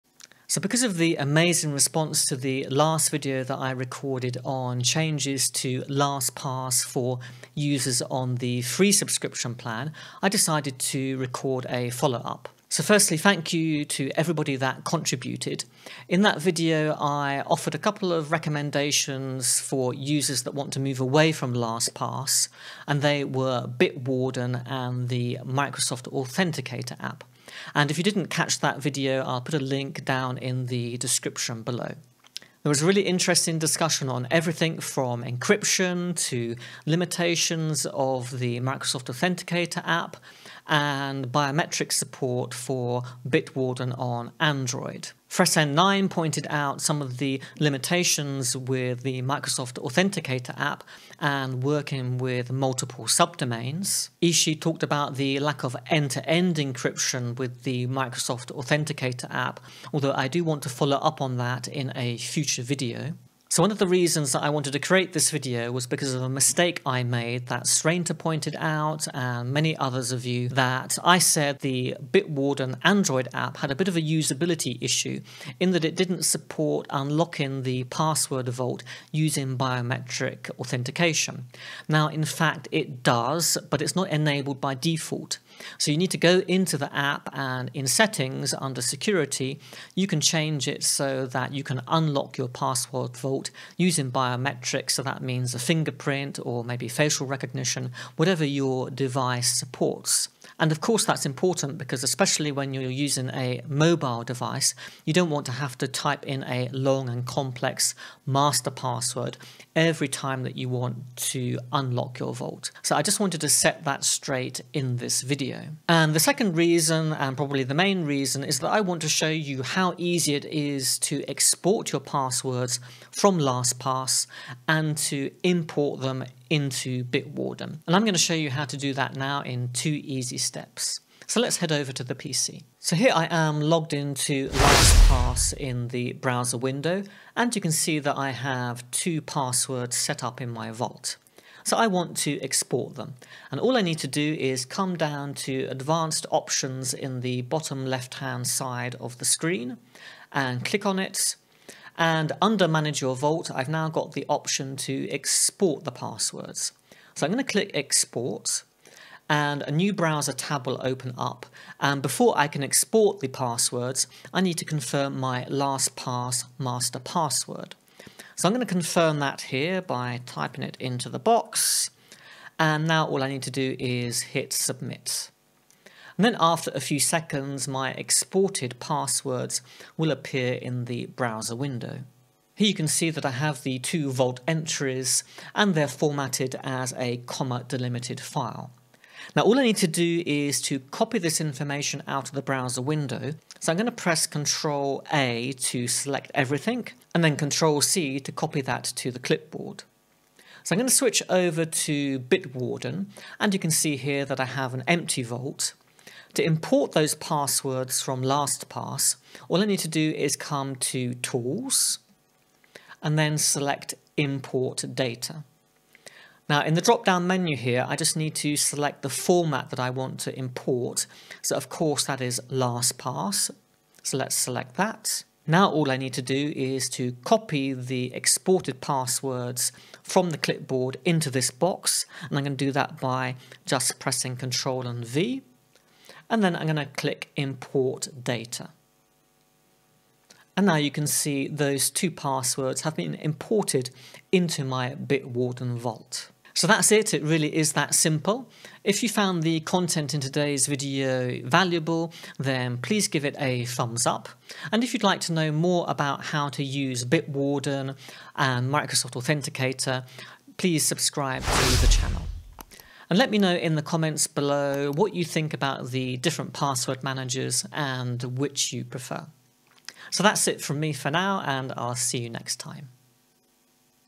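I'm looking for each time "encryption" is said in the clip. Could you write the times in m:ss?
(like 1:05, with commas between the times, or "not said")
0:35, 0:56.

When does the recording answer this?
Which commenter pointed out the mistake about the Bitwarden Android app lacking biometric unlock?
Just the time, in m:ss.
1:07.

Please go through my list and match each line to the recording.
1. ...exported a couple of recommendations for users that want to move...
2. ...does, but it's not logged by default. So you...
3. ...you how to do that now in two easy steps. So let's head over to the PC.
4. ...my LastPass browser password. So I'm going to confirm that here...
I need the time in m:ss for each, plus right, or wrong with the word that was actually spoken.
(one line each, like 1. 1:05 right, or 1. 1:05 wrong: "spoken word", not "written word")
1. 0:17 wrong: "offered", not "exported"
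2. 1:23 wrong: "enabled", not "logged"
3. 2:08 right
4. 2:45 wrong: "master", not "browser".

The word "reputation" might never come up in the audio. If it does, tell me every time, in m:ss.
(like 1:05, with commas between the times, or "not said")
not said.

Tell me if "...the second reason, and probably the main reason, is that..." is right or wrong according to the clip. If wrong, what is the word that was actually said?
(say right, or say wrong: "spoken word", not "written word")
right.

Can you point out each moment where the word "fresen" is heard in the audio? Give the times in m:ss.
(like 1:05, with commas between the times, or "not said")
0:45.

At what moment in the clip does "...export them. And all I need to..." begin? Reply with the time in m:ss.
2:22.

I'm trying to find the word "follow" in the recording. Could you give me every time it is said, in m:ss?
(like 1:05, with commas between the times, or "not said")
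0:11, 1:00.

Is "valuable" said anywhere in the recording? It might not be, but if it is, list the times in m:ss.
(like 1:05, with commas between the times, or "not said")
4:11.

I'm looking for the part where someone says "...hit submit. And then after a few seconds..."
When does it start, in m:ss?
2:54.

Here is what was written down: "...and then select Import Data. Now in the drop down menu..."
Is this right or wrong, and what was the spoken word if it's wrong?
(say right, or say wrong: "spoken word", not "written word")
right.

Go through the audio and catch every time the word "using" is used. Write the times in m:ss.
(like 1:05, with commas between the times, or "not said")
1:19, 1:33, 1:42.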